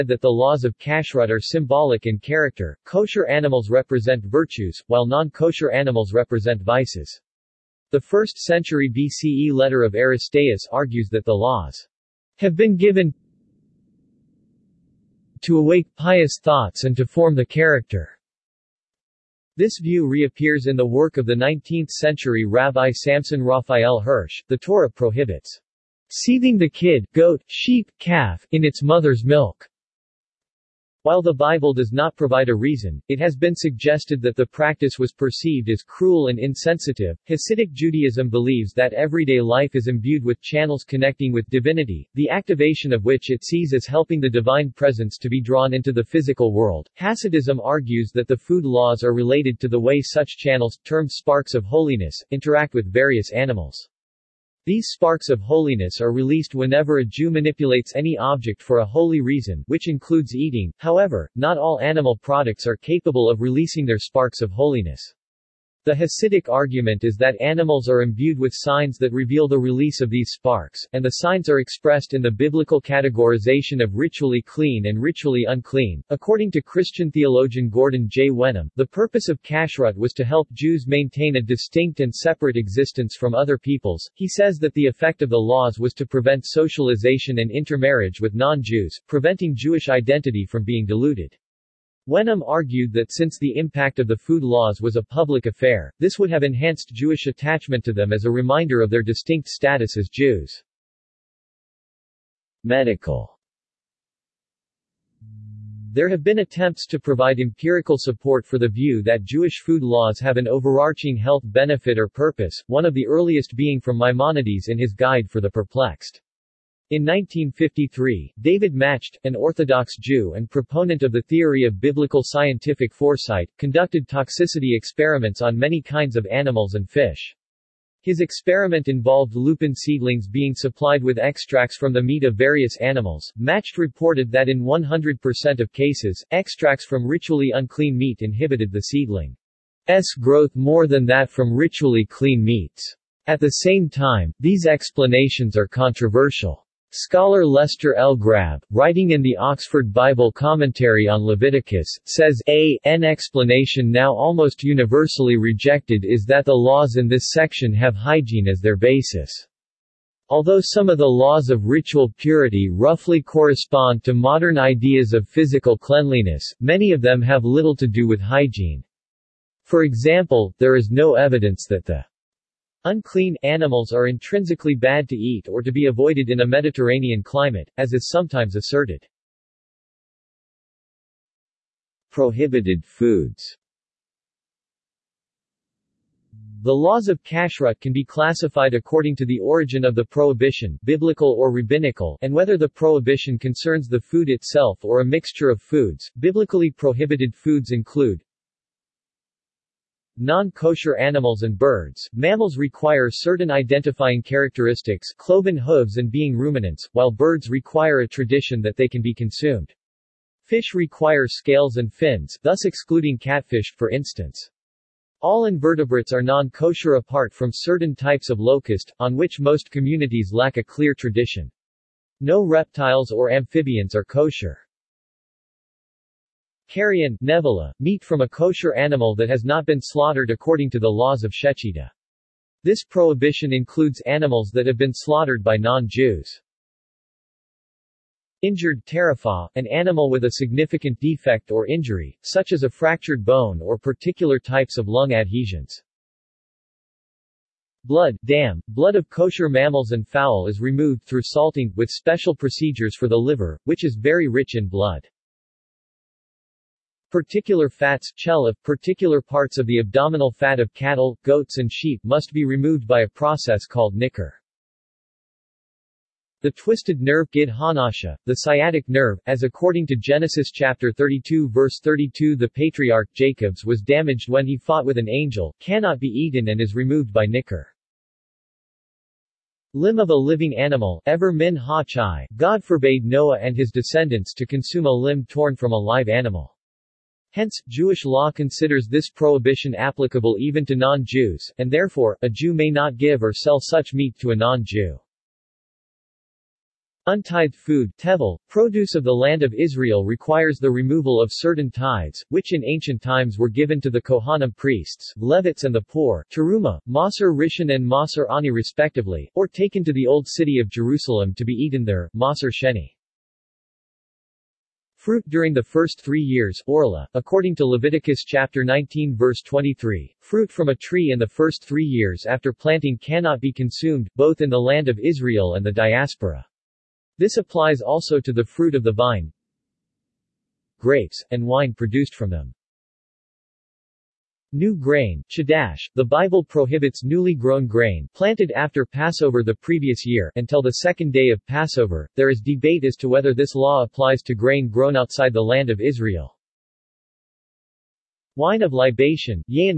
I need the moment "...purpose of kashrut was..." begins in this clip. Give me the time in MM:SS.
01:18.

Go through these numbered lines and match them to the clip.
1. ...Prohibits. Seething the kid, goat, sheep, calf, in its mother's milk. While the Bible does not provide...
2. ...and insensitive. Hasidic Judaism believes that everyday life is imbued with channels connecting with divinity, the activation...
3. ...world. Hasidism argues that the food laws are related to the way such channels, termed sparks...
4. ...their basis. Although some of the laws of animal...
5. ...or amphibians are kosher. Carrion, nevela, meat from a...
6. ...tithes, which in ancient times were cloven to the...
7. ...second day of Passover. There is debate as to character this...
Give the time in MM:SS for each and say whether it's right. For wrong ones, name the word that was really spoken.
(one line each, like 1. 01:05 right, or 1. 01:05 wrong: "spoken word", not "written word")
1. 00:24 right
2. 00:36 right
3. 00:46 right
4. 02:38 wrong: "ritual", not "animal"
5. 03:43 right
6. 05:01 wrong: "given", not "cloven"
7. 05:40 wrong: "whether", not "character".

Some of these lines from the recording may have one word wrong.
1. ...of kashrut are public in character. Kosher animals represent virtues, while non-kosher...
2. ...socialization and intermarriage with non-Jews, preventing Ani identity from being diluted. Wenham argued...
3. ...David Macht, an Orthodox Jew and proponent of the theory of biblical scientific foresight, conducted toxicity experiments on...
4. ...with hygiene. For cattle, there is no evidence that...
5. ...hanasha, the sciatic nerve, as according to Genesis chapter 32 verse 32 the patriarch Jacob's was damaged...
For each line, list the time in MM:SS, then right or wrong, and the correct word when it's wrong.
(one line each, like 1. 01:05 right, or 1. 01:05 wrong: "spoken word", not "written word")
1. 00:00 wrong: "symbolic", not "public"
2. 01:26 wrong: "Jewish", not "Ani"
3. 01:58 right
4. 02:48 wrong: "example", not "cattle"
5. 04:27 right.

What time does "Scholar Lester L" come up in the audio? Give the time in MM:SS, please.
02:26.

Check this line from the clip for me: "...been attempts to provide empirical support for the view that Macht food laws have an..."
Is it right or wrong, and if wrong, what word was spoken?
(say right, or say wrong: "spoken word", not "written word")
wrong: "Jewish", not "Macht".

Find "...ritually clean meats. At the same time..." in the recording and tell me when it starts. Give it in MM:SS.
02:21.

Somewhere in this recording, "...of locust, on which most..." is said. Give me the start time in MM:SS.
03:38.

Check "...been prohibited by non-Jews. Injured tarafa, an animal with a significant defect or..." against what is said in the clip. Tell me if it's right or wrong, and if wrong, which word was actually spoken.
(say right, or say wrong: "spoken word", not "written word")
wrong: "slaughtered", not "prohibited".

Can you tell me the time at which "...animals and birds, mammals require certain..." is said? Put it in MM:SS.
03:20.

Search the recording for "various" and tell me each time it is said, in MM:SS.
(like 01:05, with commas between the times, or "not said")
00:52, 02:12.